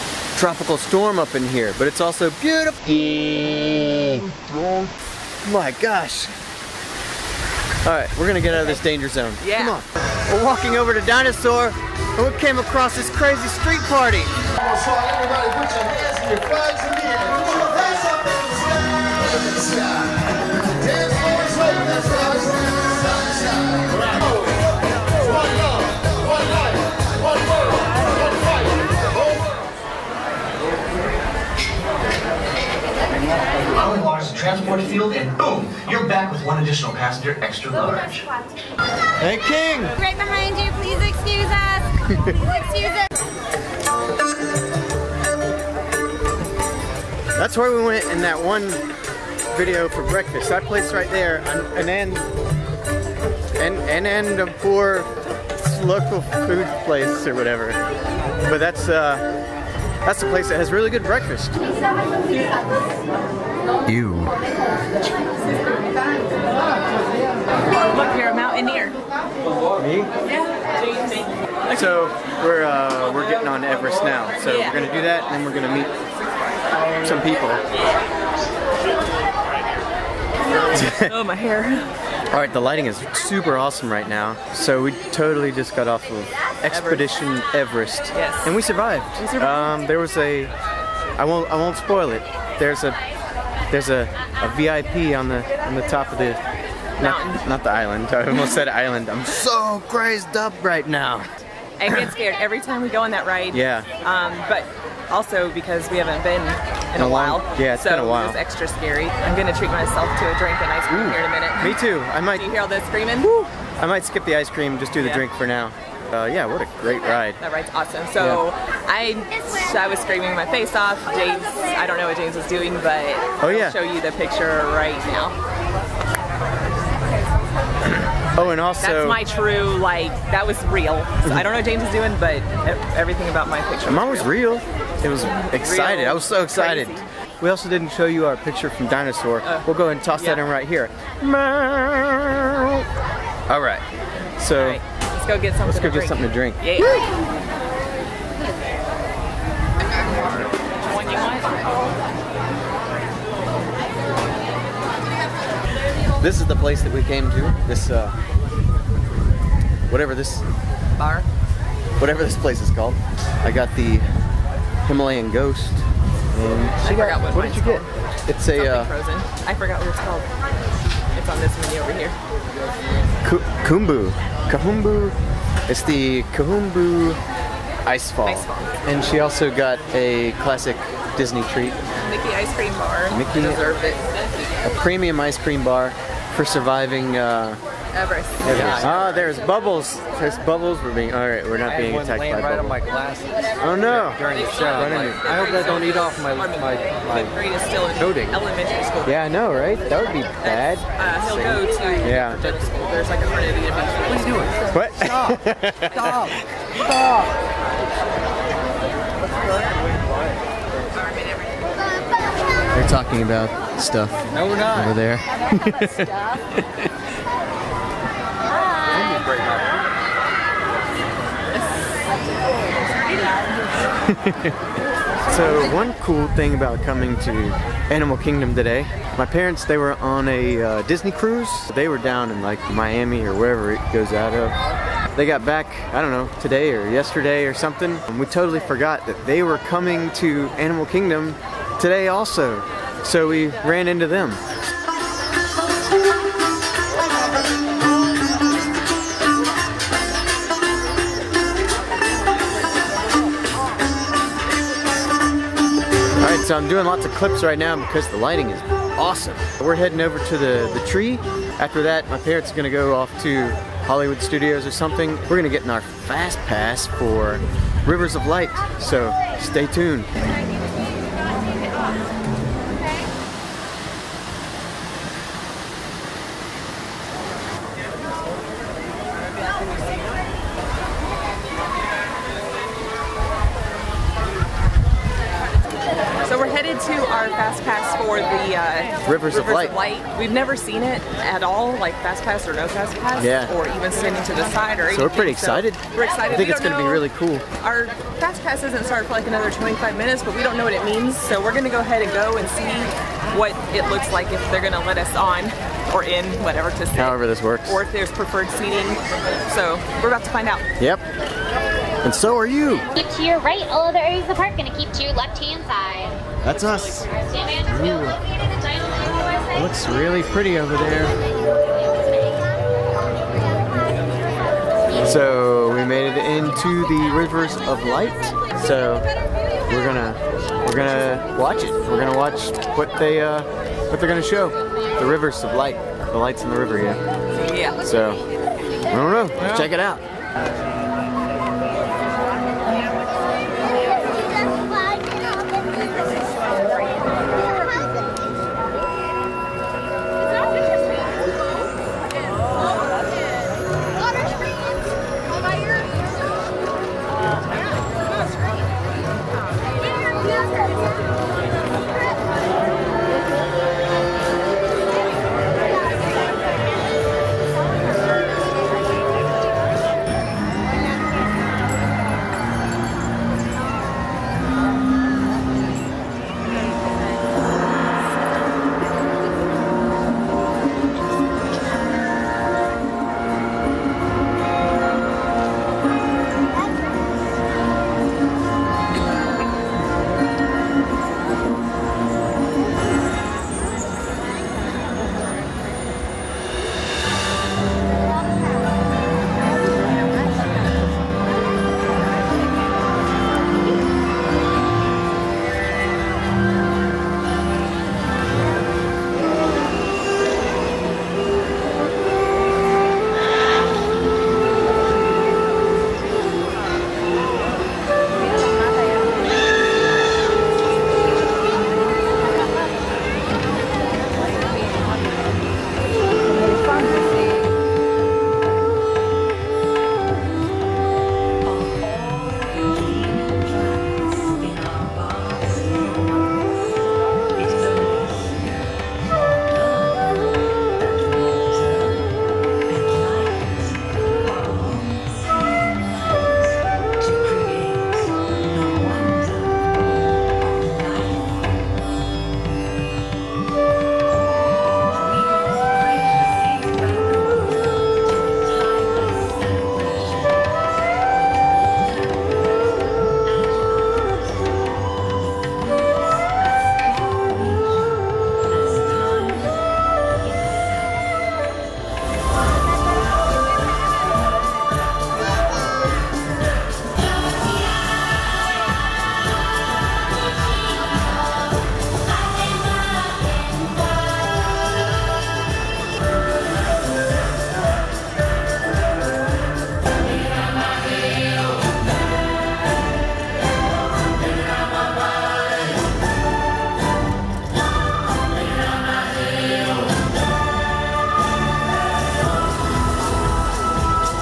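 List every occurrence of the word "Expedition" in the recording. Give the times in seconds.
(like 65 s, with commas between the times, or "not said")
86 s.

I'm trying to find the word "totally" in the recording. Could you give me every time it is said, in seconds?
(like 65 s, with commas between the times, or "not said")
85 s, 238 s.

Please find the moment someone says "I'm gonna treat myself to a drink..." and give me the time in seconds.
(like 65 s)
109 s.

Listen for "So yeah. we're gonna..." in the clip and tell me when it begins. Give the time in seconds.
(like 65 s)
74 s.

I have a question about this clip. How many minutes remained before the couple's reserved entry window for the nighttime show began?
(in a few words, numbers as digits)
25.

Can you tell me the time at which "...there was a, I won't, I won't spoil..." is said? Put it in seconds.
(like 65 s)
89 s.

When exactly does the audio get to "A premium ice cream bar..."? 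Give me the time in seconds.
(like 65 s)
184 s.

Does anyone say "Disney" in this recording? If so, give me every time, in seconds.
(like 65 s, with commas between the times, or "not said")
181 s, 230 s.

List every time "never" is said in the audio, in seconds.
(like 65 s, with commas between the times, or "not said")
290 s.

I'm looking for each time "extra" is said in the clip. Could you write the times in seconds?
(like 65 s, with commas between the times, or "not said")
37 s, 108 s.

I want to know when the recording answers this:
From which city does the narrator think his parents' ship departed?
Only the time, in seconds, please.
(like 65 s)
232 s.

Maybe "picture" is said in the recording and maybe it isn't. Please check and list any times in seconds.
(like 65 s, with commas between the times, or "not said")
124 s, 133 s, 138 s.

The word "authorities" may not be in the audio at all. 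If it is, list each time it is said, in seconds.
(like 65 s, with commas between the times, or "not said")
not said.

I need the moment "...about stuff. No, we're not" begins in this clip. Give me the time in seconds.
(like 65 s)
213 s.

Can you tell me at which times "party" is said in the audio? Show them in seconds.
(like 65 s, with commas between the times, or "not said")
13 s.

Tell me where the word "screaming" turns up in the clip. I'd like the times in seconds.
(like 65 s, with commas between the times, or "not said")
112 s, 119 s.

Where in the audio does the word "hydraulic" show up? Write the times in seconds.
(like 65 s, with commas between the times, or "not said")
not said.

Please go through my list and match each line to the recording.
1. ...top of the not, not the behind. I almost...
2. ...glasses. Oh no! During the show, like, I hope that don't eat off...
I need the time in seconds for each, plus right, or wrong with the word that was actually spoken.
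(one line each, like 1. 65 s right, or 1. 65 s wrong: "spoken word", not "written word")
1. 95 s wrong: "island", not "behind"
2. 192 s right.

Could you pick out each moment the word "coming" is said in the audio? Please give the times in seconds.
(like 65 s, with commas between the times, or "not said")
226 s, 239 s.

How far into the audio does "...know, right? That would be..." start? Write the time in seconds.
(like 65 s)
199 s.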